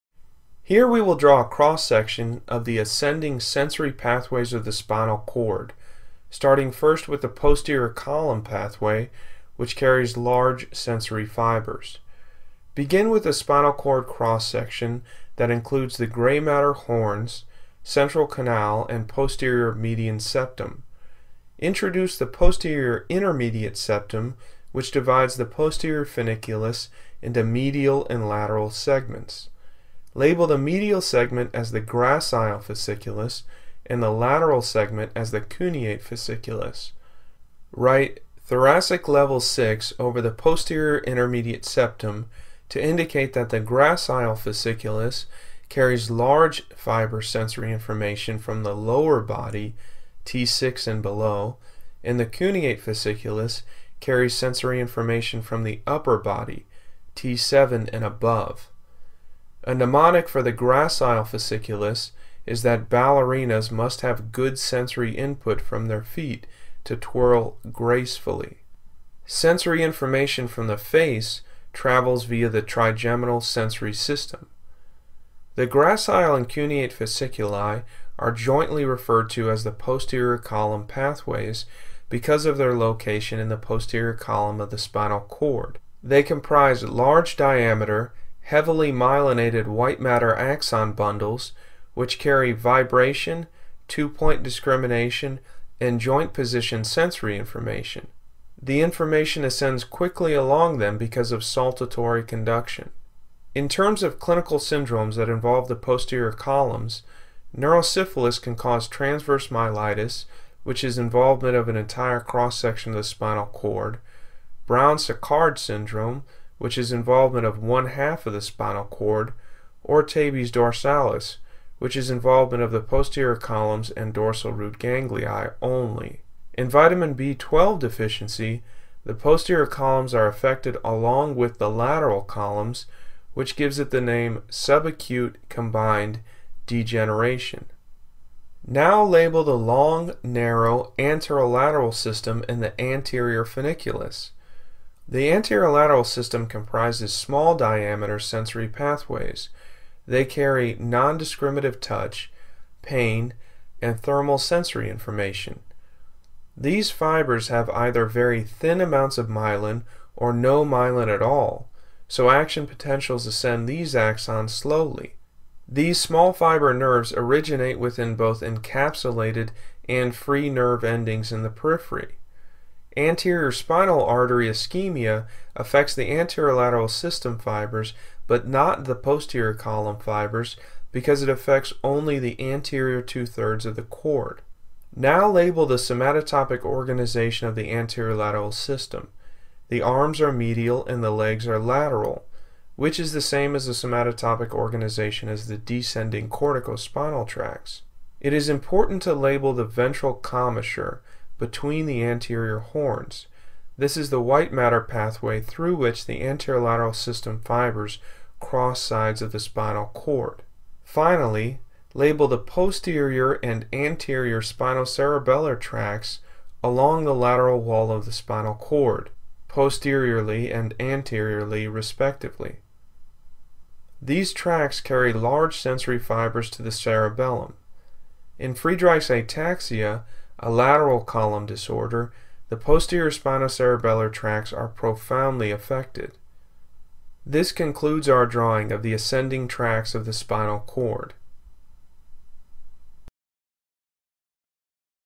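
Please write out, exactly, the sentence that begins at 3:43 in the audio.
These tracts carry large sensory fibers to the cerebellum.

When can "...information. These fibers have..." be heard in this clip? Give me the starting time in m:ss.
2:34.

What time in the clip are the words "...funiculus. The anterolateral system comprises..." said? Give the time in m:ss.
2:23.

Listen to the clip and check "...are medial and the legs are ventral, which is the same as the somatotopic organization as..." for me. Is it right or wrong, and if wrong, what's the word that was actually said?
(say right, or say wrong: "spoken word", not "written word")
wrong: "lateral", not "ventral".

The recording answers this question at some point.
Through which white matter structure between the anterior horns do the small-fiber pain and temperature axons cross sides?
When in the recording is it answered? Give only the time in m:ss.
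3:19.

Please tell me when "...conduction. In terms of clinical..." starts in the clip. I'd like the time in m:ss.
1:42.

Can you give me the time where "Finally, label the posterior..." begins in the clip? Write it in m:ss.
3:30.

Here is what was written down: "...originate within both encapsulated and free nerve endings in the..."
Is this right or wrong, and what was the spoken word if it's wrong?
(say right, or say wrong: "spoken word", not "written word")
right.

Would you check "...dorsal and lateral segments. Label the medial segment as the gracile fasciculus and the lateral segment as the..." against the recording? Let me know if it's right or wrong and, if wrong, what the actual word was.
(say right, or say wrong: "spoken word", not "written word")
wrong: "medial", not "dorsal".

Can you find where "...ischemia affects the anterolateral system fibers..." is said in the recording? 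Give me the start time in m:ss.
2:54.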